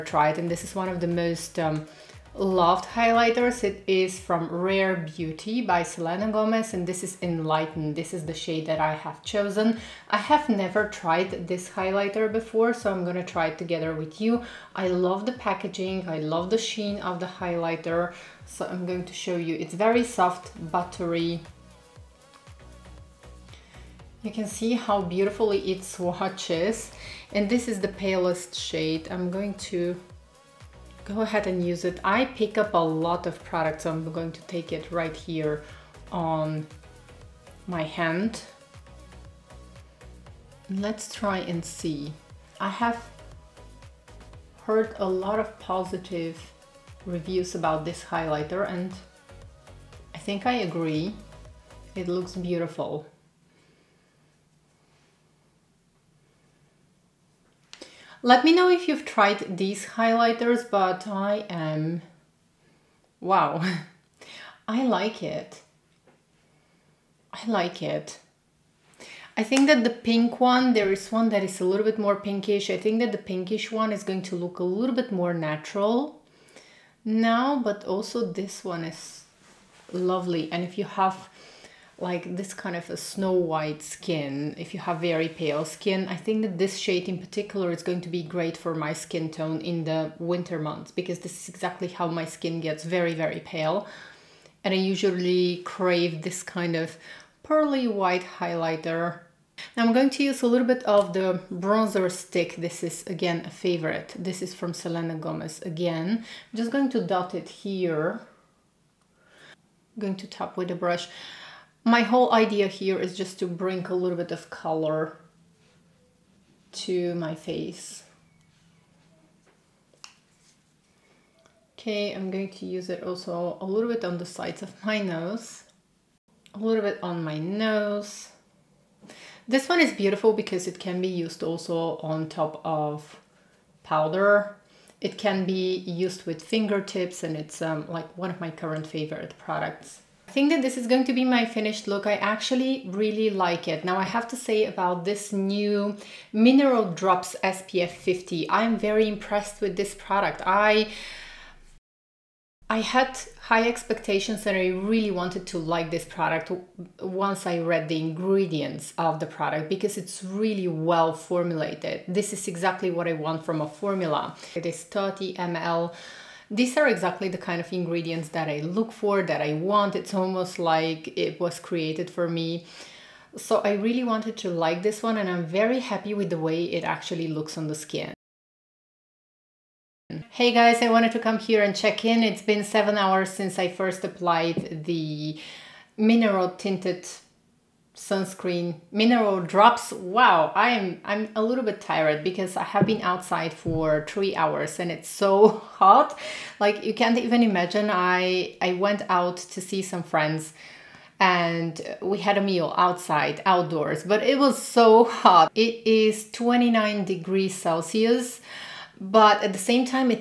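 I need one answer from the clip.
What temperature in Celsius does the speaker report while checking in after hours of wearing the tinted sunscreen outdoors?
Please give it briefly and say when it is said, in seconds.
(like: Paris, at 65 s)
29 degrees, at 206 s.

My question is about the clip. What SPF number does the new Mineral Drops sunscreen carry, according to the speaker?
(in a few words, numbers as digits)
50.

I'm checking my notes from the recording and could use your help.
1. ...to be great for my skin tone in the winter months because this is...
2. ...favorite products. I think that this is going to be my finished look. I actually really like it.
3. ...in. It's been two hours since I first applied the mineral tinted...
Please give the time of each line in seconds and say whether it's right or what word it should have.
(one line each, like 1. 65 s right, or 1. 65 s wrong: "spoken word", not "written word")
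1. 88 s right
2. 138 s right
3. 182 s wrong: "seven", not "two".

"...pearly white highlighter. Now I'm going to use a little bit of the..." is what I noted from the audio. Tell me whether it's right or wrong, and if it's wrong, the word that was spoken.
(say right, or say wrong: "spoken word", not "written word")
right.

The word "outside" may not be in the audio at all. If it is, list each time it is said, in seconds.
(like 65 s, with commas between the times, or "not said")
193 s, 202 s.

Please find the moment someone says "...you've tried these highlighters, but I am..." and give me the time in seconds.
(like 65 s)
58 s.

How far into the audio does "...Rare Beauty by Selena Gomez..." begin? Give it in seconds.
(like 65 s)
4 s.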